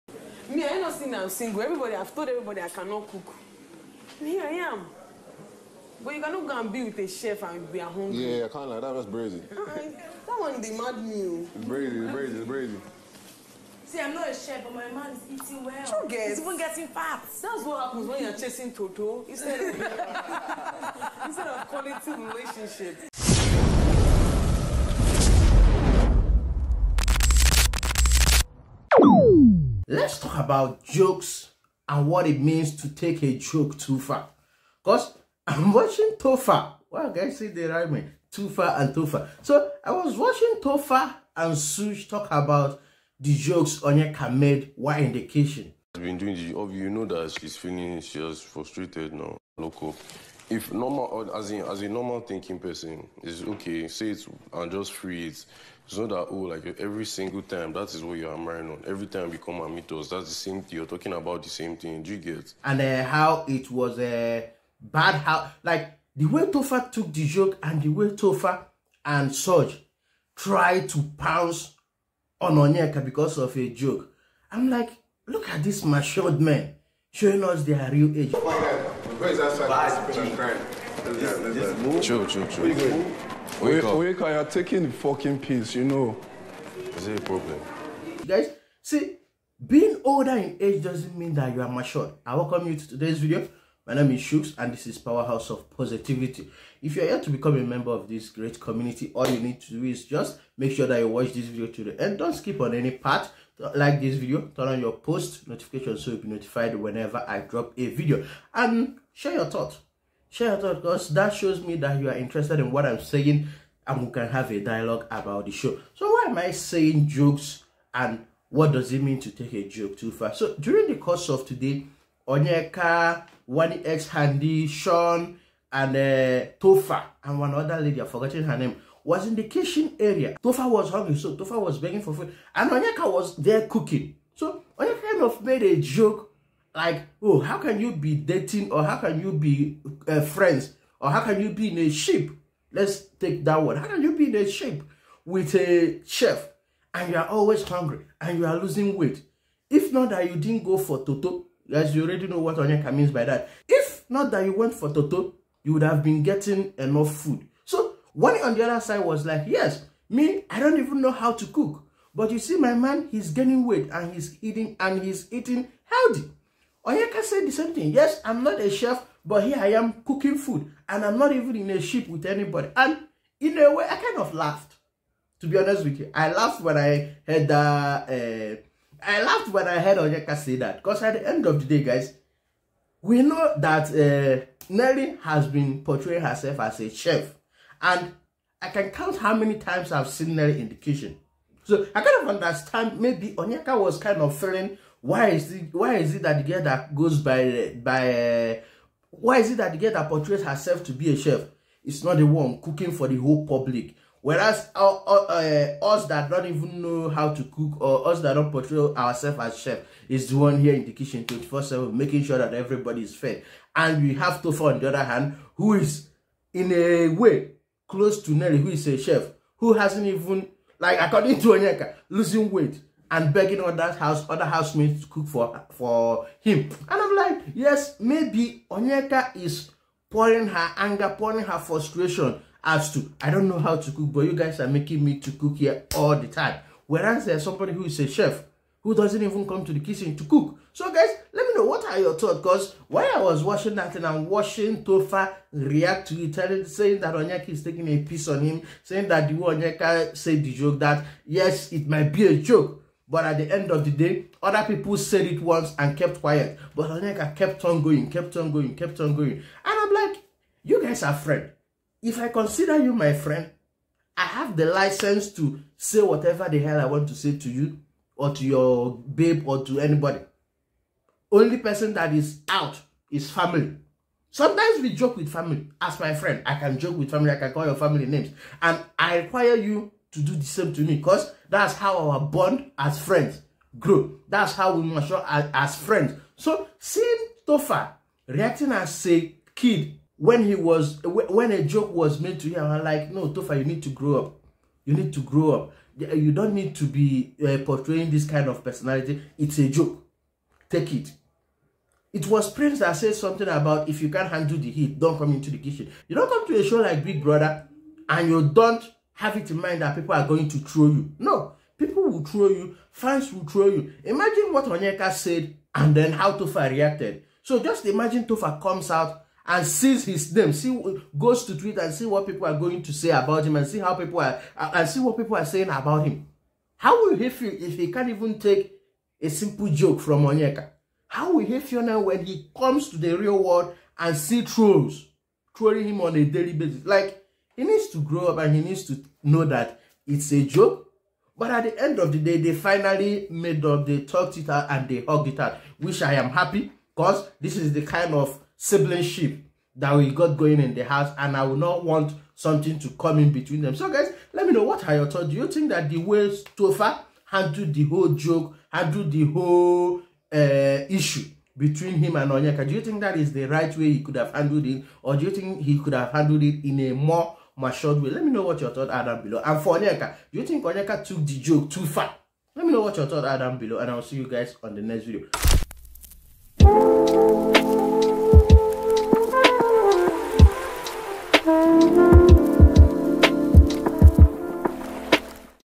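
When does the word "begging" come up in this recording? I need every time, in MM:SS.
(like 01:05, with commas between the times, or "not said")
02:11, 03:43.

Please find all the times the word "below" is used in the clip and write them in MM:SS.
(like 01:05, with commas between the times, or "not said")
06:09, 06:13.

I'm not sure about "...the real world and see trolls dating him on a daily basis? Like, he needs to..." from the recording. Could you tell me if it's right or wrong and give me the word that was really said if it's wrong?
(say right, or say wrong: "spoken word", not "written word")
wrong: "trolling", not "dating".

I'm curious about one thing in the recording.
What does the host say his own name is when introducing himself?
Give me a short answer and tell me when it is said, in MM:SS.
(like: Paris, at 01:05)
Chuks, at 01:34.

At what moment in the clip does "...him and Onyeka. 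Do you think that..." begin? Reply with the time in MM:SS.
06:01.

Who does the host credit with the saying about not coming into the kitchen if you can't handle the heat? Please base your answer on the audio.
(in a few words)
Prince.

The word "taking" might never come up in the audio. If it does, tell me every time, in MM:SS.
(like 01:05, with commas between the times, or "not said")
01:24, 04:07.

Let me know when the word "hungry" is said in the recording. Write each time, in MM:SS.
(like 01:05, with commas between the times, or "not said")
02:10, 02:27.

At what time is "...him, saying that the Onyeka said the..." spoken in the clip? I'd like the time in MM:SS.
04:08.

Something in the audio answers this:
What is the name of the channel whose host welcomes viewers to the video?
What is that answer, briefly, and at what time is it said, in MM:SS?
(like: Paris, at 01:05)
Powerhouse of Positivity, at 01:34.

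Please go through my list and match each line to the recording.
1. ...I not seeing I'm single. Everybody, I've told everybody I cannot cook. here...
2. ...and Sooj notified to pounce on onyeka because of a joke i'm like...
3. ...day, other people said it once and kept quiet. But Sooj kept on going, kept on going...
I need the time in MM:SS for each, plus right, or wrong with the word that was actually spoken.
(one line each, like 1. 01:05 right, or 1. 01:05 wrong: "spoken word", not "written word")
1. 00:00 wrong: "saying", not "seeing"
2. 01:09 wrong: "tried", not "notified"
3. 04:13 wrong: "Onyeka", not "Sooj".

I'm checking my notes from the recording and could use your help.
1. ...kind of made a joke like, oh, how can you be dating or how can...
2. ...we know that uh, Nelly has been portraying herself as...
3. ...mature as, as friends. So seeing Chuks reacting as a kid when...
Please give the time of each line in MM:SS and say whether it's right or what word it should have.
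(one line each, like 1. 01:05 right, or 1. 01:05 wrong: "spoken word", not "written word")
1. 02:15 right
2. 03:03 right
3. 04:44 wrong: "Topher", not "Chuks".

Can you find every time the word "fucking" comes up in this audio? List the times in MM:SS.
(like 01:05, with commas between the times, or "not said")
01:24.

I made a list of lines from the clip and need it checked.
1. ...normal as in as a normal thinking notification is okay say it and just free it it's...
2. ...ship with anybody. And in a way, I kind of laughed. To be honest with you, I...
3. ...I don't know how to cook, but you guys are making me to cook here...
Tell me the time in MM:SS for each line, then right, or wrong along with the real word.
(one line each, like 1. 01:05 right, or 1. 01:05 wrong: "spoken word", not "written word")
1. 00:50 wrong: "person", not "notification"
2. 02:51 right
3. 03:53 right.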